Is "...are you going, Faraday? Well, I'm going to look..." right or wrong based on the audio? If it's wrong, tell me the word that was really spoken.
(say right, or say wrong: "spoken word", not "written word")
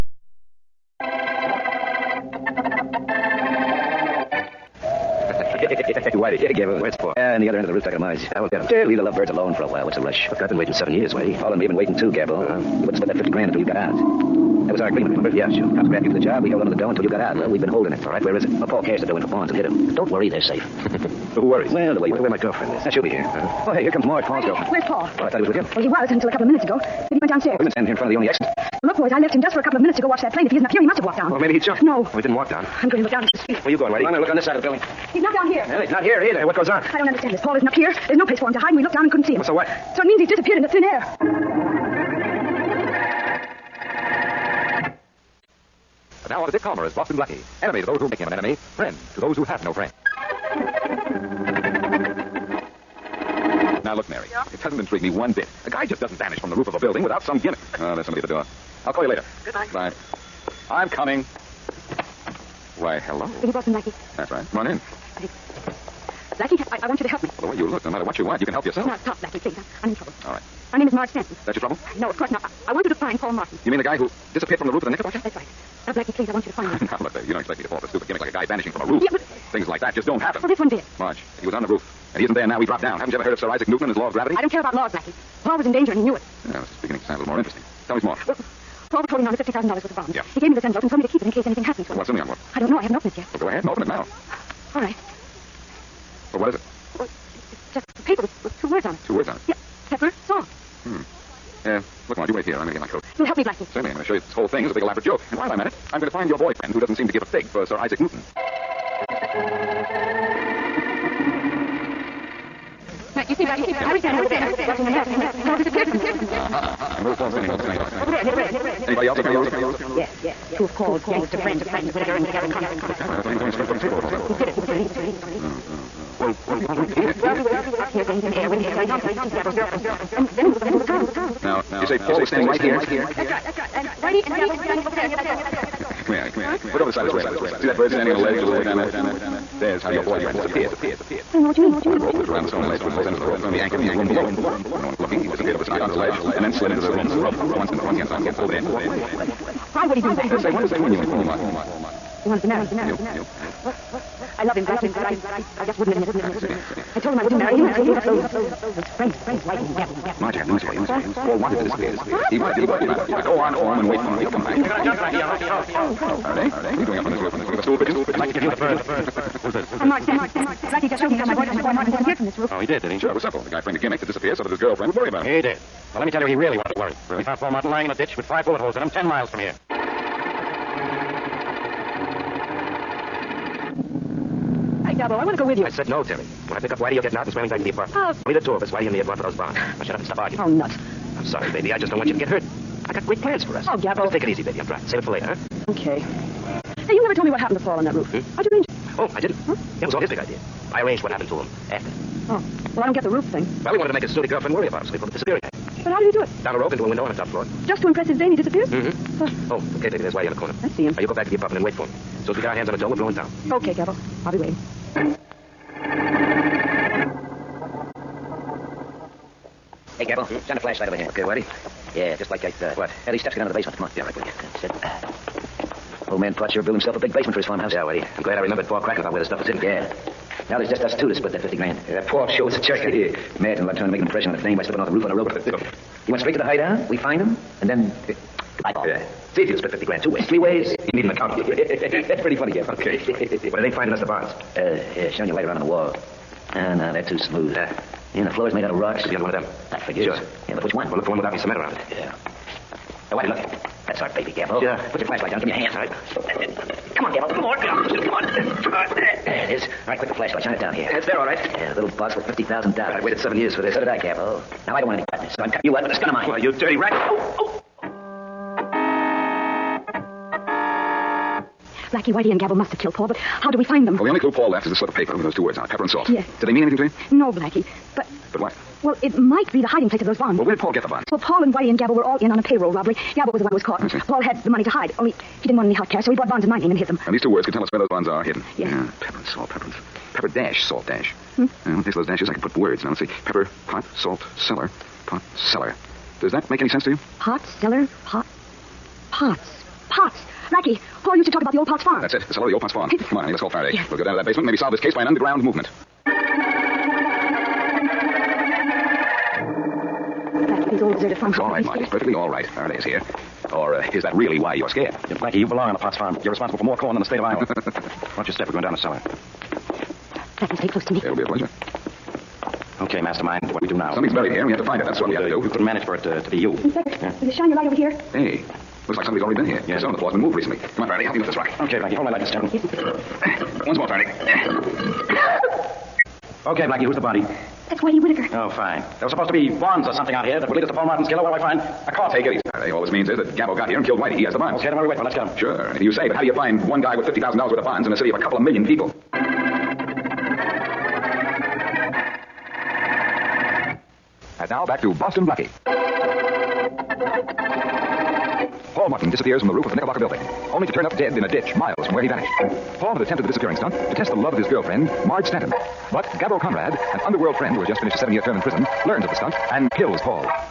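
wrong: "Whitey", not "Faraday".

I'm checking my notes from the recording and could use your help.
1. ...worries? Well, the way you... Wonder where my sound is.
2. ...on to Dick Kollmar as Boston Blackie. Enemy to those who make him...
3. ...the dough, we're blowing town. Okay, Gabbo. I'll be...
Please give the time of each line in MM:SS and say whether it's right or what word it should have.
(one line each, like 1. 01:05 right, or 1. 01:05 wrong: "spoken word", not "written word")
1. 00:21 wrong: "girlfriend", not "sound"
2. 00:46 right
3. 03:32 right.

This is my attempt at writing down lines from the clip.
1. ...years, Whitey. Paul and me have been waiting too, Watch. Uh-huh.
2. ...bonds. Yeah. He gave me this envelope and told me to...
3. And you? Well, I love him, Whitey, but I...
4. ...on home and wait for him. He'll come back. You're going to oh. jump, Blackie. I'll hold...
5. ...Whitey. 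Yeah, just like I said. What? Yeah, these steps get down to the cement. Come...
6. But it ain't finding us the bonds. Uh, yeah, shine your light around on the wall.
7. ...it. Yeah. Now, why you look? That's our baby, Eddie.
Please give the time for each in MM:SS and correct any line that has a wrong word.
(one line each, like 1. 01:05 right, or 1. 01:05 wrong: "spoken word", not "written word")
1. 00:10 wrong: "Gabbo", not "Watch"
2. 01:29 right
3. 02:32 wrong: "Blackie", not "Whitey"
4. 02:43 right
5. 03:41 wrong: "basement", not "cement"
6. 04:03 right
7. 04:11 wrong: "Capo", not "Eddie".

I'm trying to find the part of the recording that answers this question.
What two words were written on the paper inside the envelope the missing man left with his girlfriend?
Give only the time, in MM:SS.
01:39.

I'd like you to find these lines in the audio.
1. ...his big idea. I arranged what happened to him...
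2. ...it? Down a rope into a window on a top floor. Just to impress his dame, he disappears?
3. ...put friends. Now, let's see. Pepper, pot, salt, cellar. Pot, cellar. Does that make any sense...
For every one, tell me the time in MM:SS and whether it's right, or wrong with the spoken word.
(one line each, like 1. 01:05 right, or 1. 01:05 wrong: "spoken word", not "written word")
1. 03:19 right
2. 03:26 right
3. 04:52 wrong: "words", not "friends".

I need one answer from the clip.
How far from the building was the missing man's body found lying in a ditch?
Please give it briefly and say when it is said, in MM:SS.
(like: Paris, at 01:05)
10 miles, at 02:58.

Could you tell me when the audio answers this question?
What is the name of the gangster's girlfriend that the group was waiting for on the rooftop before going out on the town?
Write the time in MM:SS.
02:08.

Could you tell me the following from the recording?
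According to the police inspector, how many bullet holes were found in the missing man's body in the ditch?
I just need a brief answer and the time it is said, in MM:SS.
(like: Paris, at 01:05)
5, at 02:58.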